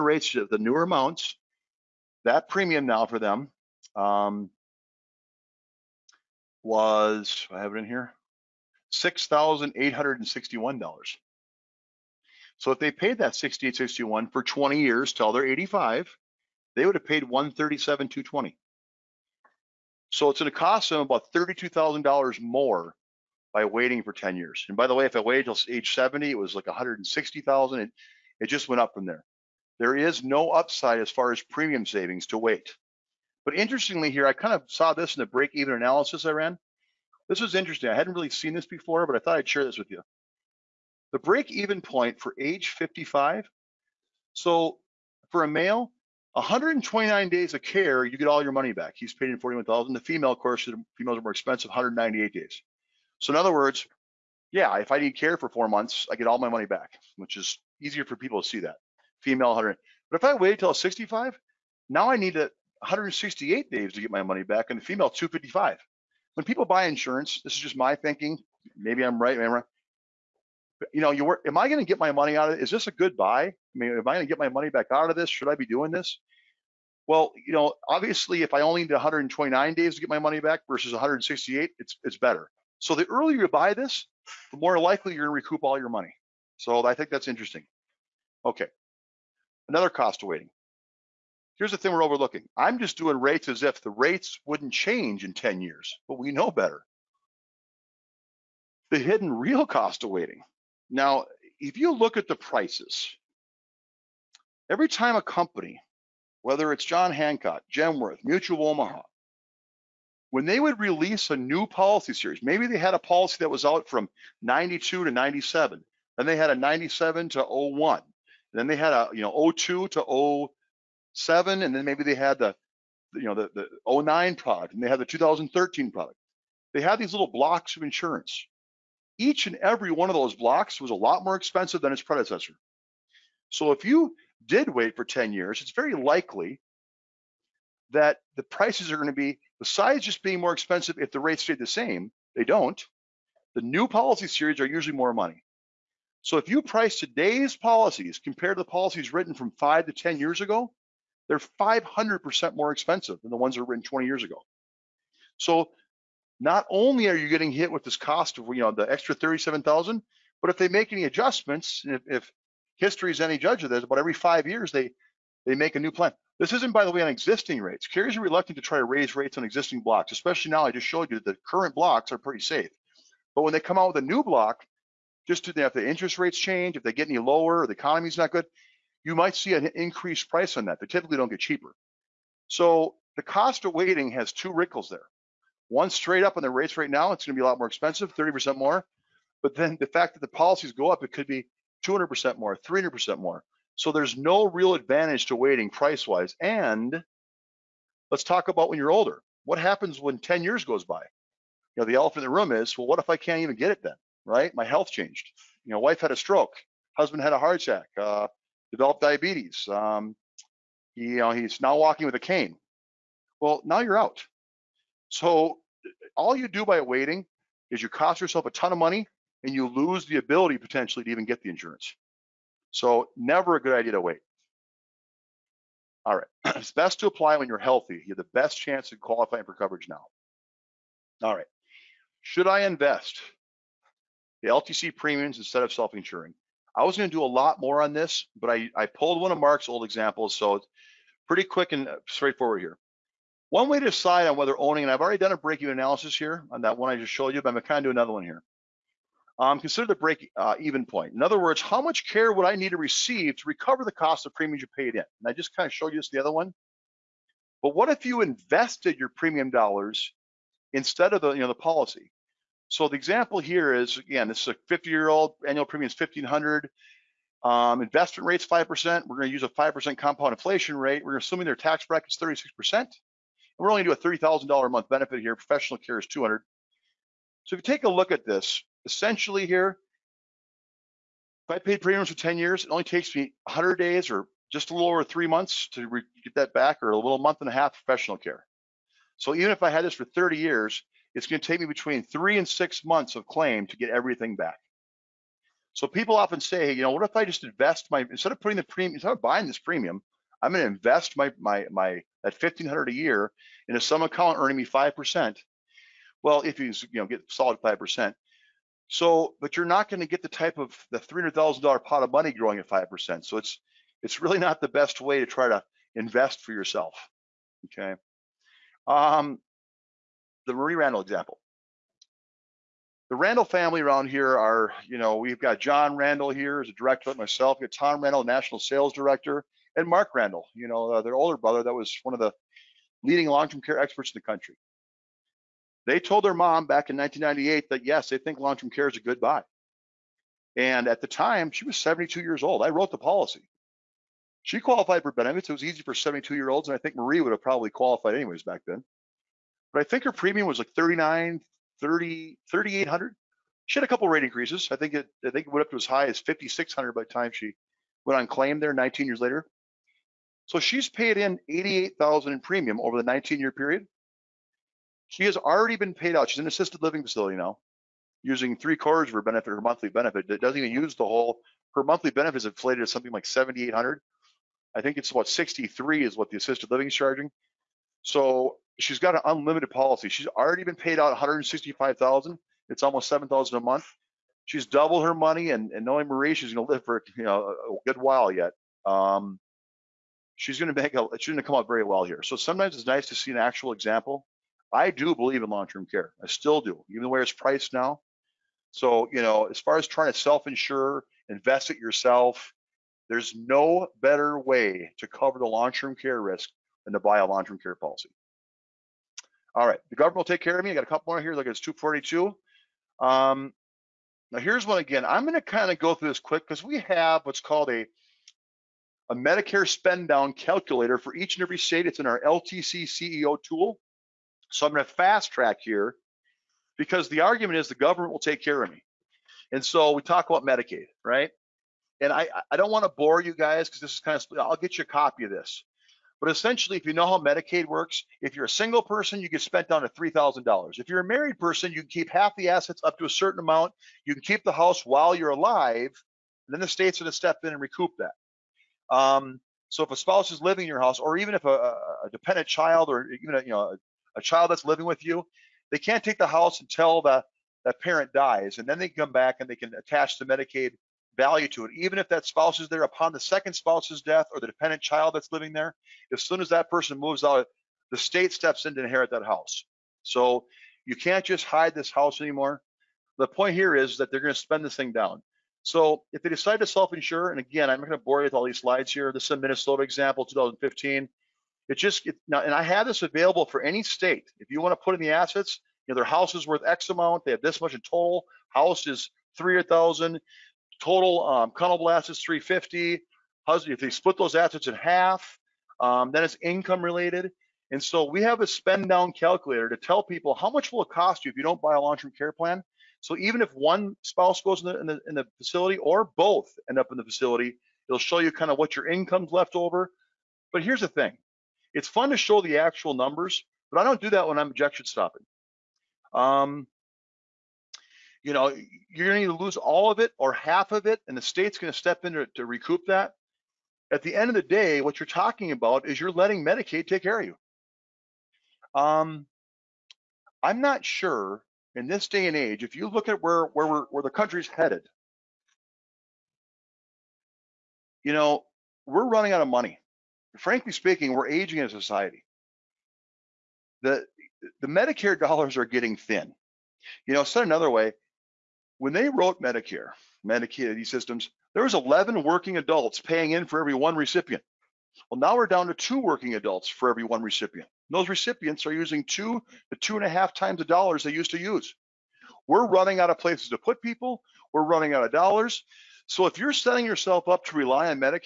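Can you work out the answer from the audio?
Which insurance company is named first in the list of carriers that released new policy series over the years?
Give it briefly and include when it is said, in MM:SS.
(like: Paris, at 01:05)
John Hancock, at 01:46.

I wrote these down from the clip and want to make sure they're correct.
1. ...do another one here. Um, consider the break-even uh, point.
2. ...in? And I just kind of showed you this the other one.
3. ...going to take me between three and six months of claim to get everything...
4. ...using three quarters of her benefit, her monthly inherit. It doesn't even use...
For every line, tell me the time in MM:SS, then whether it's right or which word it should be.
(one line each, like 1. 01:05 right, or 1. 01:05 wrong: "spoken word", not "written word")
1. 04:07 right
2. 04:14 right
3. 04:51 right
4. 06:08 wrong: "benefit", not "inherit".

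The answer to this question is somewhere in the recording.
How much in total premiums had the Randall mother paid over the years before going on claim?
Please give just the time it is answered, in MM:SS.
06:01.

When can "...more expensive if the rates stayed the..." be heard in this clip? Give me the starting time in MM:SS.
02:20.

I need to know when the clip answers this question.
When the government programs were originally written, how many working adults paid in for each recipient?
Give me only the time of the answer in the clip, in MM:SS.
09:11.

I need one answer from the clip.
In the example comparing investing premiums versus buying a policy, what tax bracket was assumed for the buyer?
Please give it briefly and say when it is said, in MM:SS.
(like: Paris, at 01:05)
36%, at 04:32.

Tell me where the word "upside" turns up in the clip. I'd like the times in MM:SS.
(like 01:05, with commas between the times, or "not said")
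00:30.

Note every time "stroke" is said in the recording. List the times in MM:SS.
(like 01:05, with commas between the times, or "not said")
03:26.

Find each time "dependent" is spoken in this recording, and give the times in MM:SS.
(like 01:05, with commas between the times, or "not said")
07:32, 07:44.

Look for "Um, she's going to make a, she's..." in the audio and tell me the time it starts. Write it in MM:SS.
06:28.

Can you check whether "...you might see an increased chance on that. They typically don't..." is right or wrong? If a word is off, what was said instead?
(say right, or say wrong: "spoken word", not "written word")
wrong: "price", not "chance".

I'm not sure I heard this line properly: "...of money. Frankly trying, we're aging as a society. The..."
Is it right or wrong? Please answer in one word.
wrong.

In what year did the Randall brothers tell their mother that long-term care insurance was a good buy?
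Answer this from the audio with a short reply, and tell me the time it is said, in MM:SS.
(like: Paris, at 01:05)
1998, at 05:36.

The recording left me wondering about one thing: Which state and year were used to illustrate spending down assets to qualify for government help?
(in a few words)
Minnesota, 2015.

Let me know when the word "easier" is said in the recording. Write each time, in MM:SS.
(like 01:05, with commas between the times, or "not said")
00:57.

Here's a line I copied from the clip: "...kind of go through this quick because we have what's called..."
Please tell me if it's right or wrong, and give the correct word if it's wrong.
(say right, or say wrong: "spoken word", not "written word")
right.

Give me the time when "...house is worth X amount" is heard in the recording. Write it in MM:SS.
08:06.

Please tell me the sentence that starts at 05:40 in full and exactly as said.
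And at the time, she was 72 years old.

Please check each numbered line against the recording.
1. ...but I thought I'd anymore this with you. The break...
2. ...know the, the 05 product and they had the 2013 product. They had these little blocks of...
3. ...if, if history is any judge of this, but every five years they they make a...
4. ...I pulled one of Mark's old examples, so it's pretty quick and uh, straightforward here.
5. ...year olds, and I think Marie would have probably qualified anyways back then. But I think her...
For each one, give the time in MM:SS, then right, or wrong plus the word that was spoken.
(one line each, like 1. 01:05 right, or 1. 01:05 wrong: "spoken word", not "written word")
1. 00:39 wrong: "share", not "anymore"
2. 02:03 wrong: "09", not "05"
3. 02:41 right
4. 03:58 right
5. 05:46 right.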